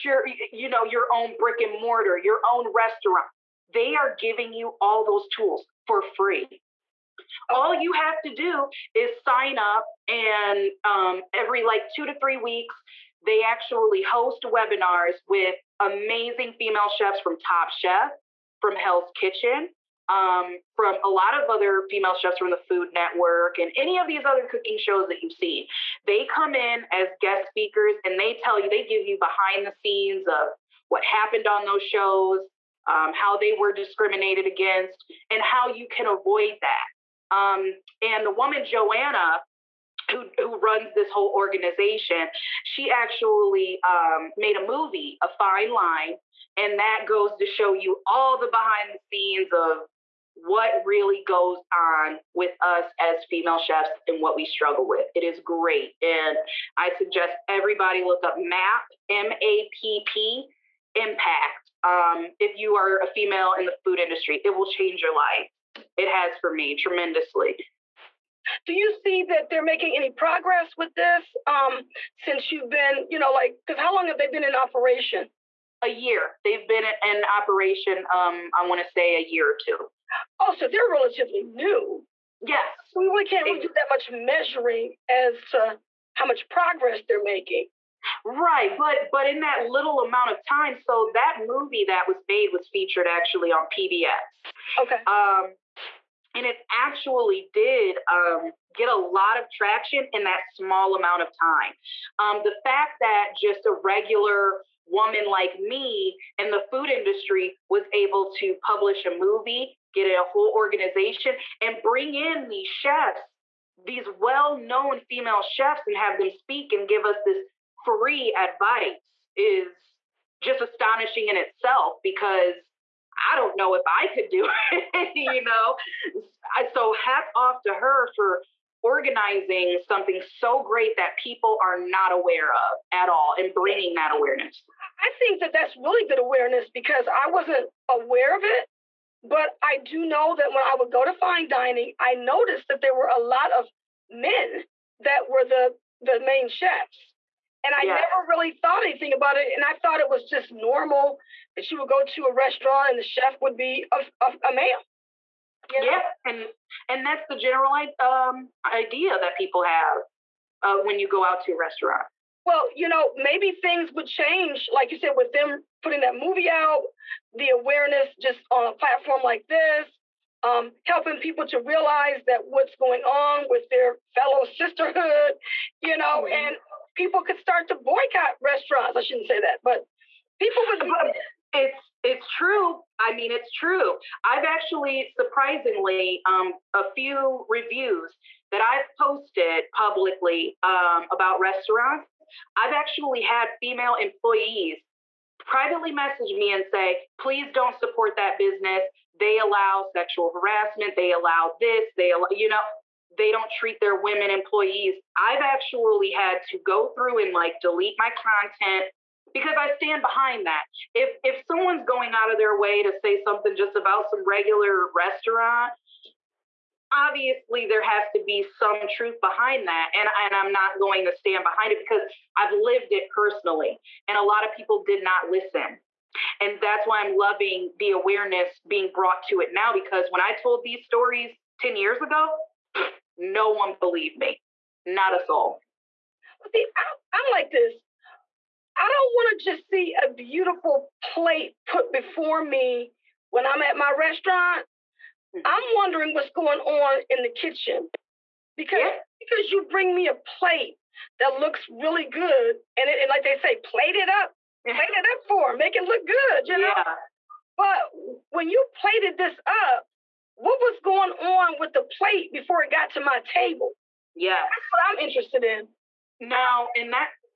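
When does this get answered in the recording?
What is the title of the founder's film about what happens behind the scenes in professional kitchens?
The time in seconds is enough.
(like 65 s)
45 s.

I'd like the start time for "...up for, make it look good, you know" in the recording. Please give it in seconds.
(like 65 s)
255 s.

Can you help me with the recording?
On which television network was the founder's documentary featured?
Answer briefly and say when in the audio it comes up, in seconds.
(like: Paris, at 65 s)
PBS, at 93 s.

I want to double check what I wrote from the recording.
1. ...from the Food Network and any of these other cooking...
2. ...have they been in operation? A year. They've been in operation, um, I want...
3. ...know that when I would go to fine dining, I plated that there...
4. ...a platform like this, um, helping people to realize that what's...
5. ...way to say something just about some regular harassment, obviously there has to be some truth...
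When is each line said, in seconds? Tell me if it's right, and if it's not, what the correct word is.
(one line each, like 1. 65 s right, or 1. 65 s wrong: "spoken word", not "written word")
1. 22 s right
2. 74 s right
3. 140 s wrong: "noticed", not "plated"
4. 168 s right
5. 212 s wrong: "restaurant", not "harassment".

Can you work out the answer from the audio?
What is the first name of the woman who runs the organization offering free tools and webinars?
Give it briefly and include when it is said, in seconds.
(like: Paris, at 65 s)
Joanna, at 38 s.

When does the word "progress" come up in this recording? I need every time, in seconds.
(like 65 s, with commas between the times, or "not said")
70 s, 86 s.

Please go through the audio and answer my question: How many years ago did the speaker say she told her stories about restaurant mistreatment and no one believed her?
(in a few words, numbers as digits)
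10.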